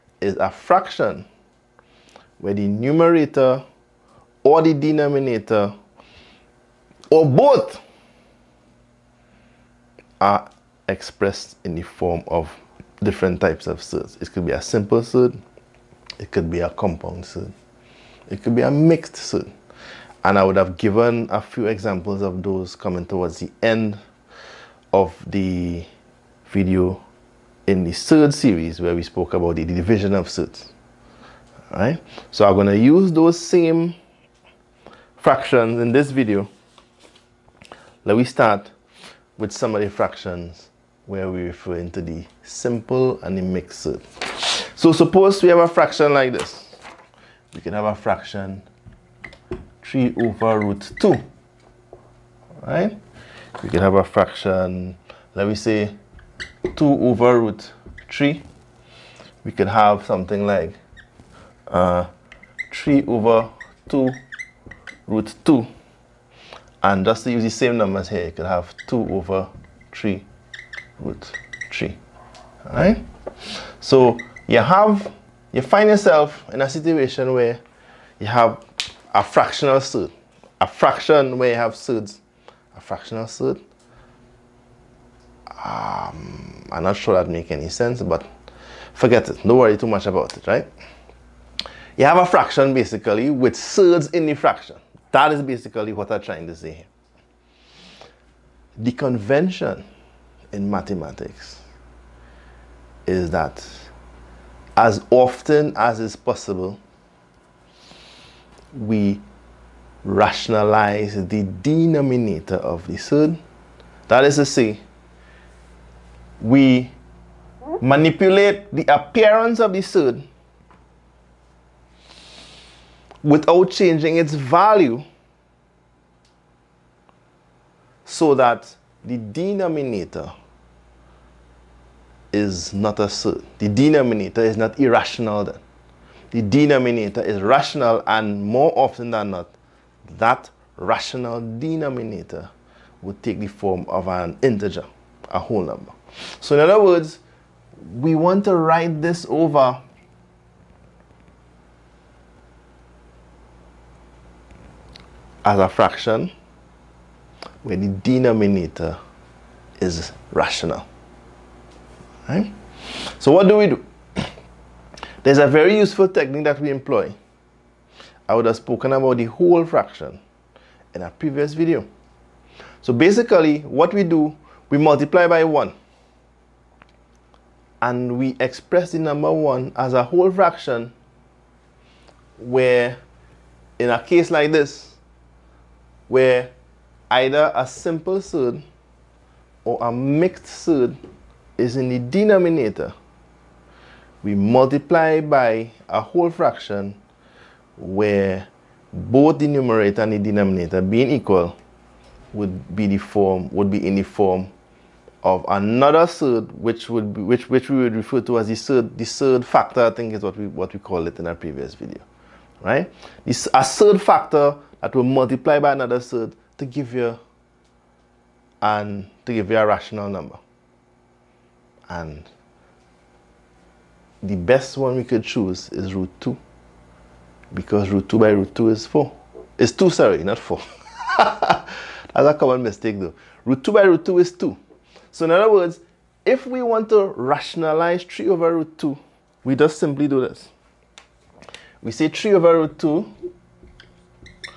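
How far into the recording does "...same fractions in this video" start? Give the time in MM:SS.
00:33.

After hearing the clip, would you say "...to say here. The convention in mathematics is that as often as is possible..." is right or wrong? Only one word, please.
right.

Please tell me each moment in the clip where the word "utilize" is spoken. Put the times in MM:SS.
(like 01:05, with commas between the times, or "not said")
not said.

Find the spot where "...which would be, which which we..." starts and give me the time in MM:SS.
03:26.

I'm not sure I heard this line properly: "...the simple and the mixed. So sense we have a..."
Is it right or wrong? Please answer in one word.
wrong.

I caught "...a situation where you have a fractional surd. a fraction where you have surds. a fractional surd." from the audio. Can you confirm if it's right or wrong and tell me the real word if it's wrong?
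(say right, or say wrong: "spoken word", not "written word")
right.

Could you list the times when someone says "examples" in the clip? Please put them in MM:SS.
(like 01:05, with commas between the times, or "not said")
00:21.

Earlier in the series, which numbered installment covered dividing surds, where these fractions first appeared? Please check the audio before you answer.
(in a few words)
third.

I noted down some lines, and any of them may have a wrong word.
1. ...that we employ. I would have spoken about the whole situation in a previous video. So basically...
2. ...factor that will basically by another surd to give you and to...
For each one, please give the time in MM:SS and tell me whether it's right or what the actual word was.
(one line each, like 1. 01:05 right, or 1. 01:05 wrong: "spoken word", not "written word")
1. 02:46 wrong: "fraction", not "situation"
2. 03:34 wrong: "multiply", not "basically".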